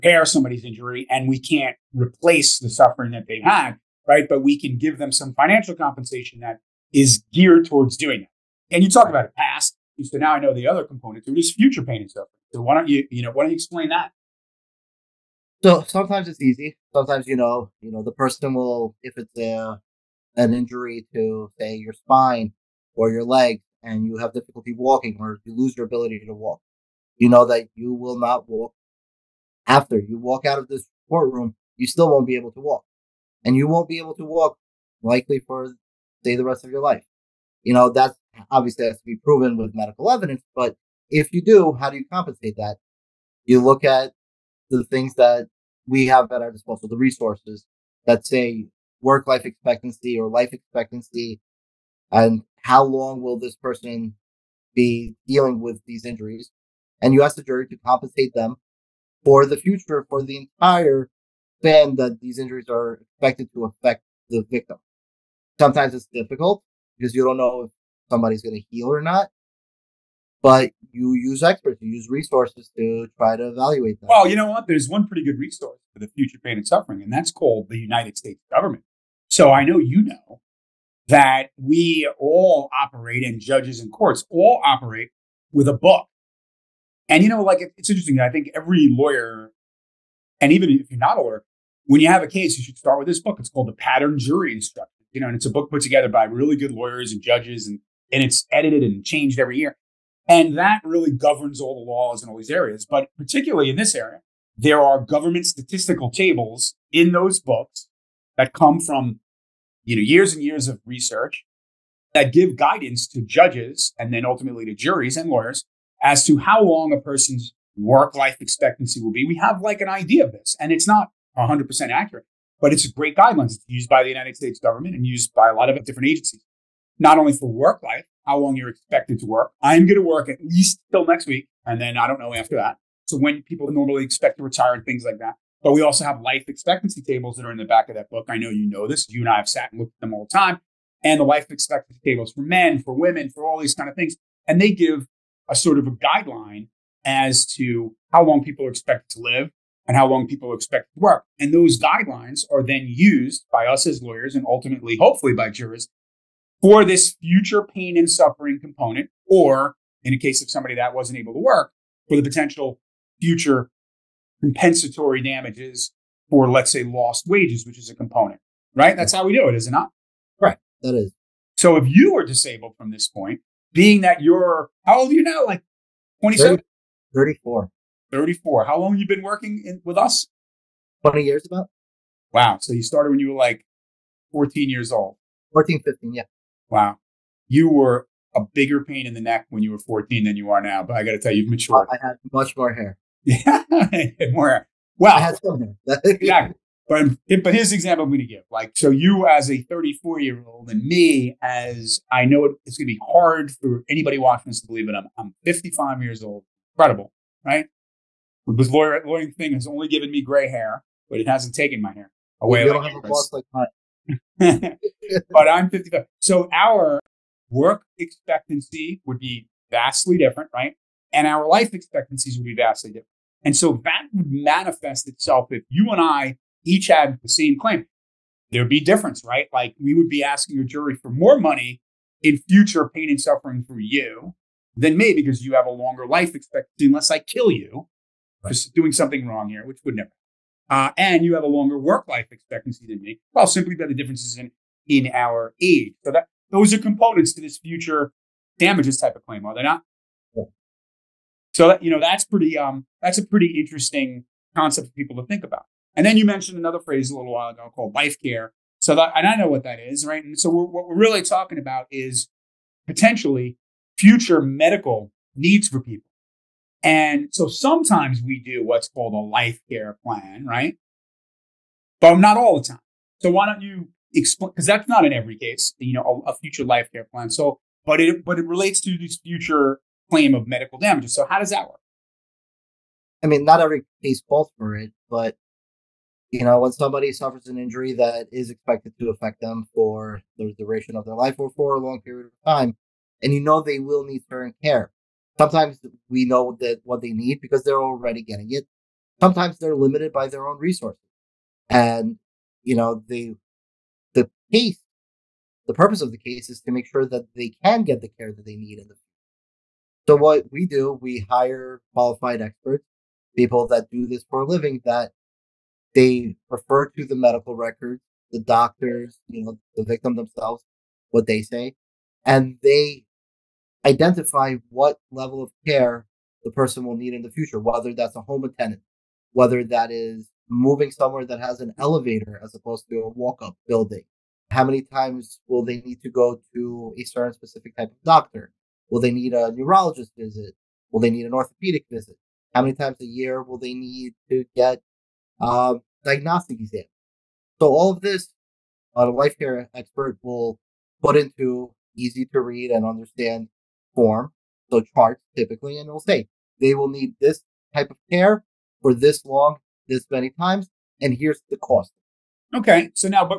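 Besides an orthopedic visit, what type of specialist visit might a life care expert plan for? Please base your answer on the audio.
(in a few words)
Neurologist.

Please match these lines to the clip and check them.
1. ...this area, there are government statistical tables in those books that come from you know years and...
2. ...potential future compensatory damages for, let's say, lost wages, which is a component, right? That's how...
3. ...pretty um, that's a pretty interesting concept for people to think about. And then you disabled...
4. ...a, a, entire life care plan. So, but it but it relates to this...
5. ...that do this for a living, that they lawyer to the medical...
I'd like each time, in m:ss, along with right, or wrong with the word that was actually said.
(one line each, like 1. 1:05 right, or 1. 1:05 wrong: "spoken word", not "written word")
1. 1:43 right
2. 2:42 right
3. 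4:12 wrong: "mentioned", not "disabled"
4. 4:36 wrong: "future", not "entire"
5. 5:13 wrong: "refer", not "lawyer".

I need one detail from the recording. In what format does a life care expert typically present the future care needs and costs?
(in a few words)
Charts.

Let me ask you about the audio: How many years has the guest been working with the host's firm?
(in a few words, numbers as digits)
About 20 years.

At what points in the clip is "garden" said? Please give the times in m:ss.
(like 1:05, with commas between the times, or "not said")
not said.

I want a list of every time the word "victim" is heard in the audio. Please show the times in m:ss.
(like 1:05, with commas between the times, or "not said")
1:04, 5:19.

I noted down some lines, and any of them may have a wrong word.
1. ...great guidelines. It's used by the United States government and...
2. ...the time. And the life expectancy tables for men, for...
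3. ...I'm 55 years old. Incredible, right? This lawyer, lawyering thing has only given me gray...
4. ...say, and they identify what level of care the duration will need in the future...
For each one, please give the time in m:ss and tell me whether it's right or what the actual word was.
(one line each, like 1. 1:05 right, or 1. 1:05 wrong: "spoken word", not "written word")
1. 2:02 right
2. 2:20 right
3. 3:25 right
4. 5:21 wrong: "person", not "duration".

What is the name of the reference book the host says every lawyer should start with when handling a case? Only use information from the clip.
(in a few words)
The Pattern Jury Instruction.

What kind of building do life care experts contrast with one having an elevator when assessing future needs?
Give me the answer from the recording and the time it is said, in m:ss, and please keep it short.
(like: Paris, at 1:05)
Walk up building, at 5:33.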